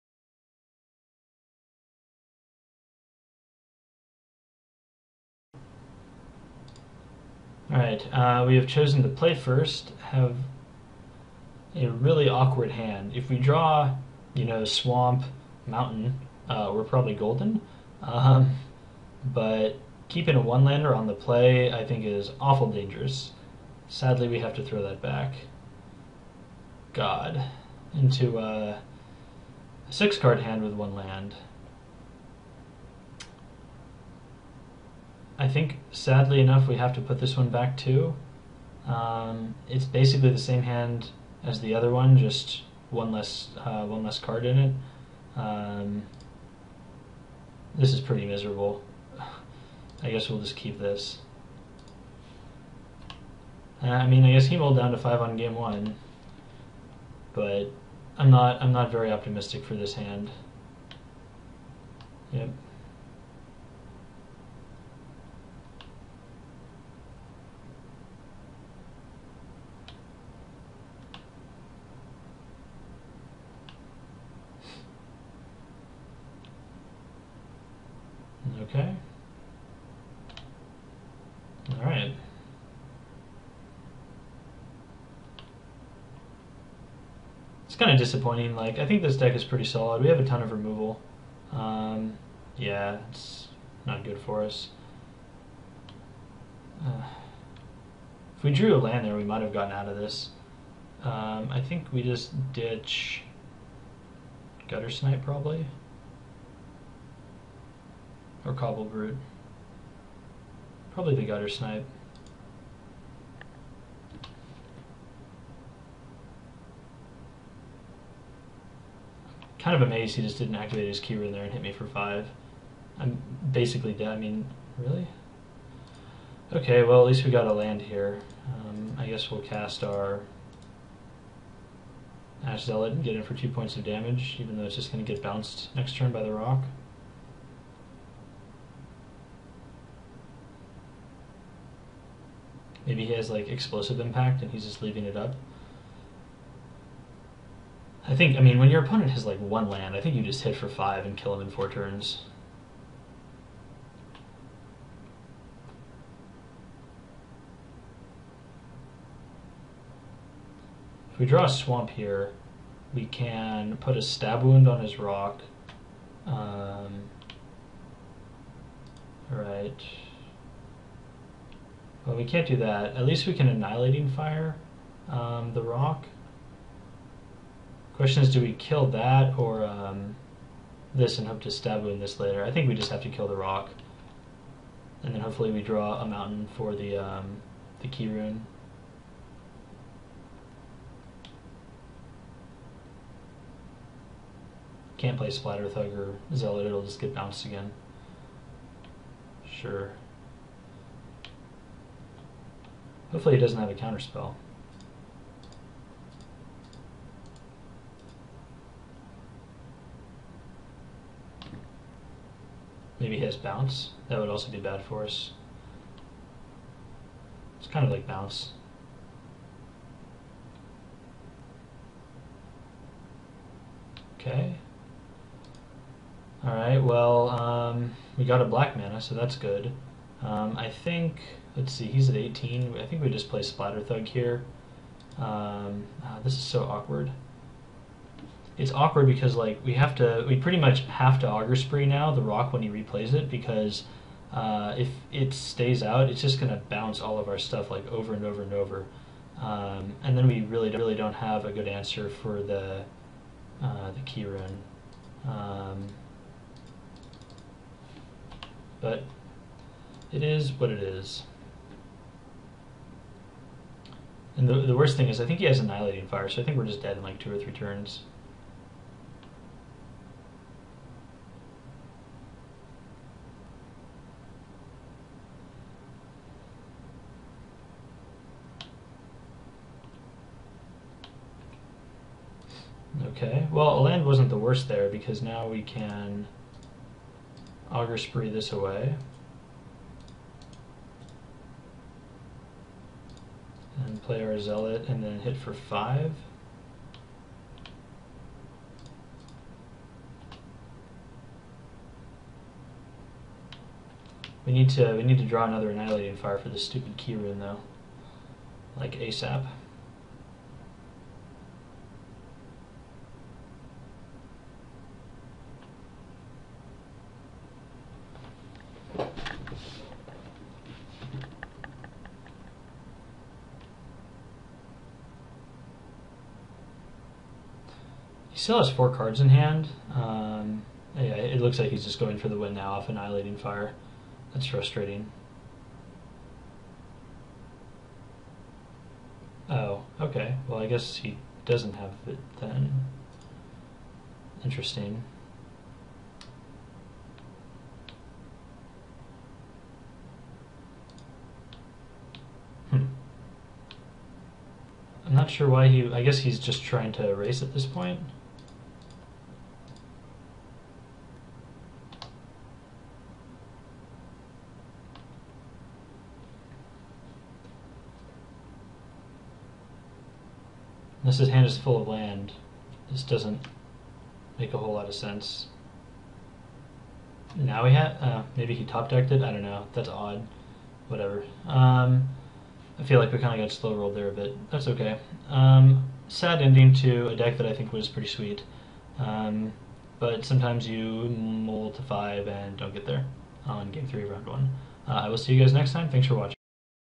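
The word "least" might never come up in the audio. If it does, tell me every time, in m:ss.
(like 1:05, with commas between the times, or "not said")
2:07, 2:53.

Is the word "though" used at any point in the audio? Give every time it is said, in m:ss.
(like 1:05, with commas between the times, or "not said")
2:14, 5:07.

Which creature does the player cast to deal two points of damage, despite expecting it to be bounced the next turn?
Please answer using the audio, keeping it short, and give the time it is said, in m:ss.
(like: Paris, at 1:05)
Ash Zealot, at 2:12.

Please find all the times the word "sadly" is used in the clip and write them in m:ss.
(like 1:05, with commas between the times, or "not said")
0:23, 0:35.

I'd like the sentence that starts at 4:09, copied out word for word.
Um, and then we really, really don't have a good answer for the, uh, the keyrune.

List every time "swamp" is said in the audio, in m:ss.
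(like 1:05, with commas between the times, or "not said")
0:14, 2:41.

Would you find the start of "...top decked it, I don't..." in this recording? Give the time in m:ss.
6:18.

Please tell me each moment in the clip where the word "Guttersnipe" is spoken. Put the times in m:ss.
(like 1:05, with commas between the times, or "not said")
1:44, 1:51.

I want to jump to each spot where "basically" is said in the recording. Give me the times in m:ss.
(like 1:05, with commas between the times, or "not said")
0:39, 2:03.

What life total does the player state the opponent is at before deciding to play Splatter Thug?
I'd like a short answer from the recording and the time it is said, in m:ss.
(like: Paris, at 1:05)
18, at 3:51.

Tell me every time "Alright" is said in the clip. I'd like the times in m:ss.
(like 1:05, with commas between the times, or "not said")
0:07, 3:46.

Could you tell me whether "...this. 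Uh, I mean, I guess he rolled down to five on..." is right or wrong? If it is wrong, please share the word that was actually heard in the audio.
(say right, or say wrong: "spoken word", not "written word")
right.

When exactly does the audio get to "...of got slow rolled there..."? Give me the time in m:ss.
6:23.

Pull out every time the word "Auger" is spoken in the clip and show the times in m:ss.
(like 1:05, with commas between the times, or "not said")
4:01, 4:47.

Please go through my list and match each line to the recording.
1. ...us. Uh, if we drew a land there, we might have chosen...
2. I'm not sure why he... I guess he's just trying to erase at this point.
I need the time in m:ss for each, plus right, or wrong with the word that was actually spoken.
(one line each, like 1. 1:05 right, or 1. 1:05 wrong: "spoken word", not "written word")
1. 1:34 wrong: "gotten", not "chosen"
2. 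5:55 right.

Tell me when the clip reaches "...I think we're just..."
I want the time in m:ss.
4:26.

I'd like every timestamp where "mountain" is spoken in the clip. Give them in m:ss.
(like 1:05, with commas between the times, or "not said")
0:15, 3:06.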